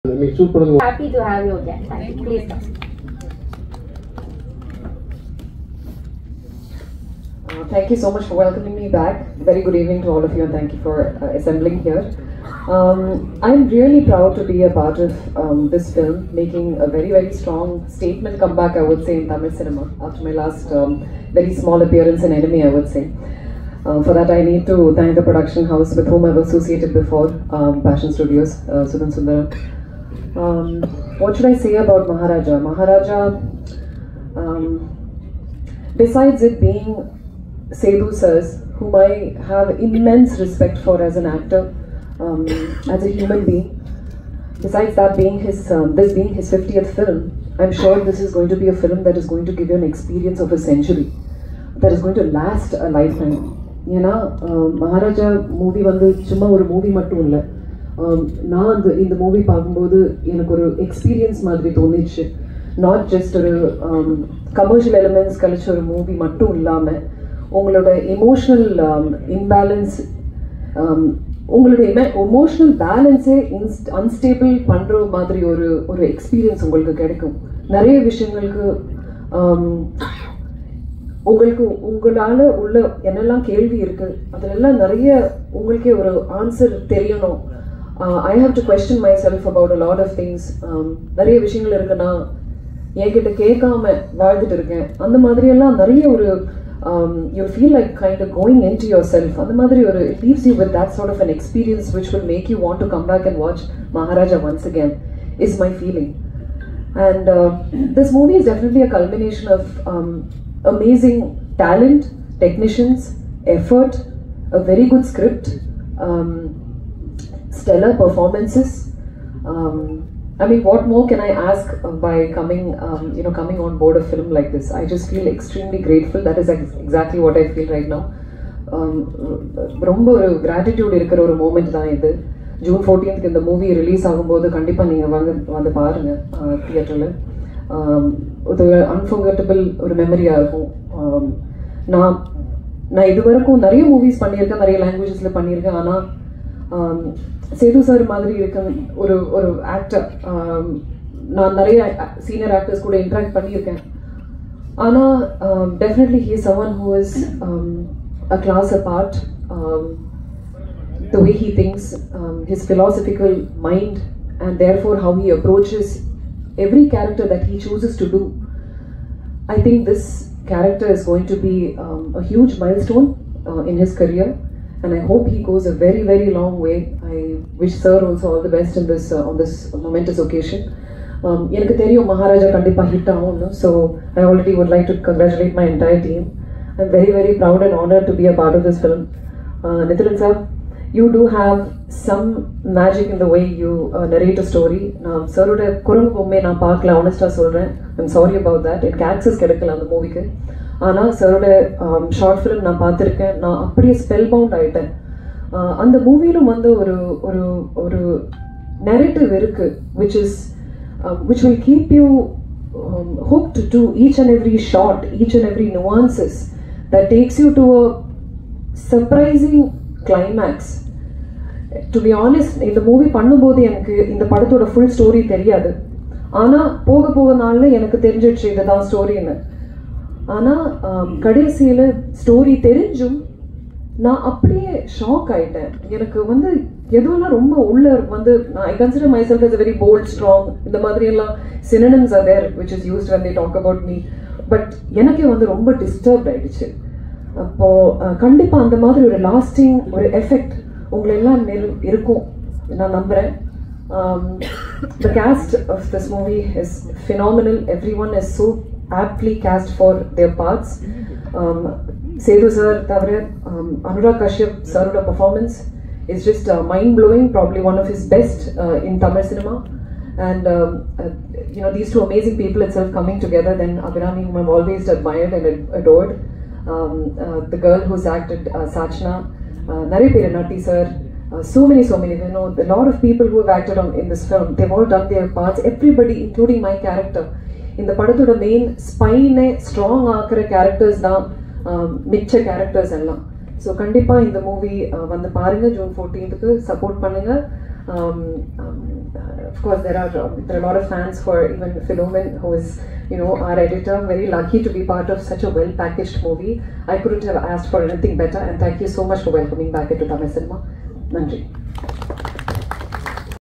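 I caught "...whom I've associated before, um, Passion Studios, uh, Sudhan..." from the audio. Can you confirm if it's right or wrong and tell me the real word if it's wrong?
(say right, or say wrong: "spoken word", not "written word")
right.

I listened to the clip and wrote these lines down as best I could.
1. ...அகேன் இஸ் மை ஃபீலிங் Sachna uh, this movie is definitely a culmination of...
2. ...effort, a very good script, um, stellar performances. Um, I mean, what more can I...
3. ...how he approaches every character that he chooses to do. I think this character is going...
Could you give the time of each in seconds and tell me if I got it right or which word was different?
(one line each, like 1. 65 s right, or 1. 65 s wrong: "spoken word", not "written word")
1. 104 s wrong: "And", not "Sachna"
2. 113 s right
3. 165 s right.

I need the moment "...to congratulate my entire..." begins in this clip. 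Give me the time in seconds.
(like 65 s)
184 s.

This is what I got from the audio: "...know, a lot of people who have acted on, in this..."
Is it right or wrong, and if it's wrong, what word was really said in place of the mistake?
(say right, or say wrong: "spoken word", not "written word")
right.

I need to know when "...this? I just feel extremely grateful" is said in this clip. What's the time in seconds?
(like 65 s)
124 s.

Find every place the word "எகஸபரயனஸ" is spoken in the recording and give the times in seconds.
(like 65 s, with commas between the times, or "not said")
60 s, 76 s, 101 s.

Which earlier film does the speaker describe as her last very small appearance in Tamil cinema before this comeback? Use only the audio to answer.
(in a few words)
Enemy.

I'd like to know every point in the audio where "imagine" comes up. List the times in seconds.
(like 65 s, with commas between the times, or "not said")
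not said.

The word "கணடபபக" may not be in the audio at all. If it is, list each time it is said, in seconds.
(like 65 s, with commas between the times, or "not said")
134 s, 248 s, 293 s.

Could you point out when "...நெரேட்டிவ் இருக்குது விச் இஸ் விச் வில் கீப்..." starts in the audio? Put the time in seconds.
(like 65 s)
208 s.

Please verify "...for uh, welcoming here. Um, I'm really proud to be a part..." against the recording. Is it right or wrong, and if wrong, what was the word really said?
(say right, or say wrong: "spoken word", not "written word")
wrong: "assembling", not "welcoming".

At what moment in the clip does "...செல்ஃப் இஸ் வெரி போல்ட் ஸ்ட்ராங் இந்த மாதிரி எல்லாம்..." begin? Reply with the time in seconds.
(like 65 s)
239 s.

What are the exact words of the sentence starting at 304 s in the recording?
Very lucky to be part of such a well packaged movie.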